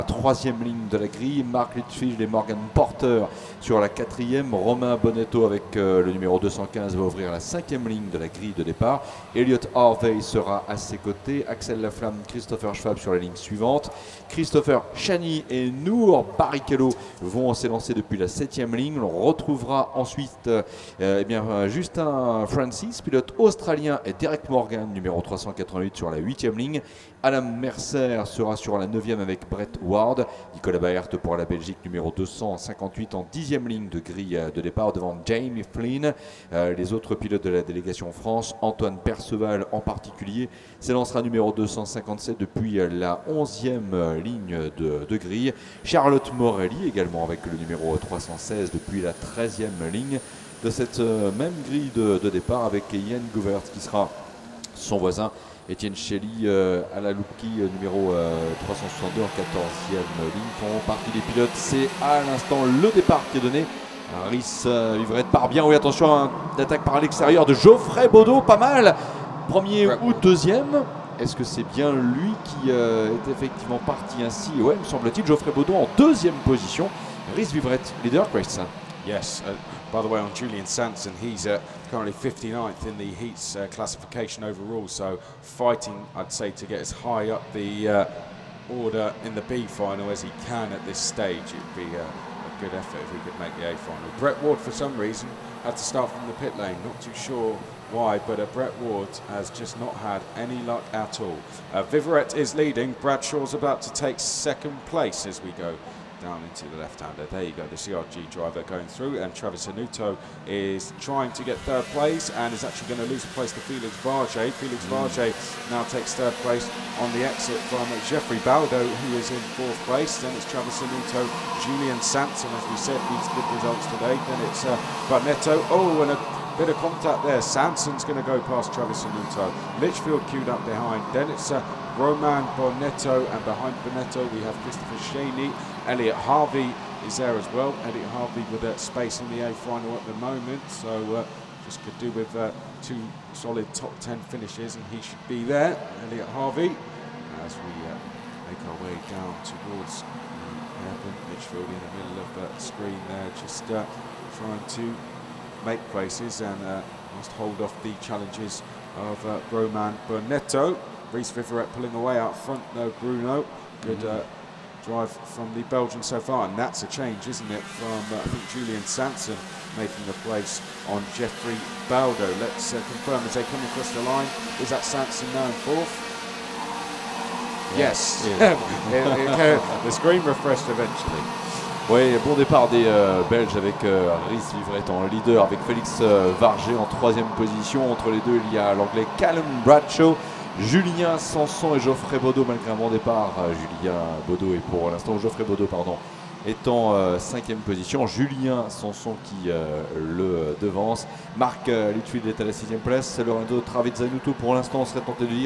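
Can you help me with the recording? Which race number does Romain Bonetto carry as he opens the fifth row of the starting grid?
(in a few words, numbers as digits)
215.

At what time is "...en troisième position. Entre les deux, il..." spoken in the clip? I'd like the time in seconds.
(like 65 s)
186 s.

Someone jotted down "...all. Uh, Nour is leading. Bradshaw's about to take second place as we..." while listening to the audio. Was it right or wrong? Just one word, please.
wrong.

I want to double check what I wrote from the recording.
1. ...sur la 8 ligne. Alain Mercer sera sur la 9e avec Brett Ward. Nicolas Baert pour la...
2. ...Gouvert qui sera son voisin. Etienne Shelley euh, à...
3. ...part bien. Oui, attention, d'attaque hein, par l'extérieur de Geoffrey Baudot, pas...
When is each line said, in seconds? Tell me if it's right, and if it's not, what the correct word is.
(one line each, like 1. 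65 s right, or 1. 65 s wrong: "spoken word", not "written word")
1. 25 s right
2. 53 s right
3. 65 s right.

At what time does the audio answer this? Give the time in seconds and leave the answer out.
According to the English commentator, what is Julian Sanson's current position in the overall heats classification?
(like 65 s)
82 s.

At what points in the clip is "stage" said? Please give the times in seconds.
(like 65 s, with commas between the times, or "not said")
90 s.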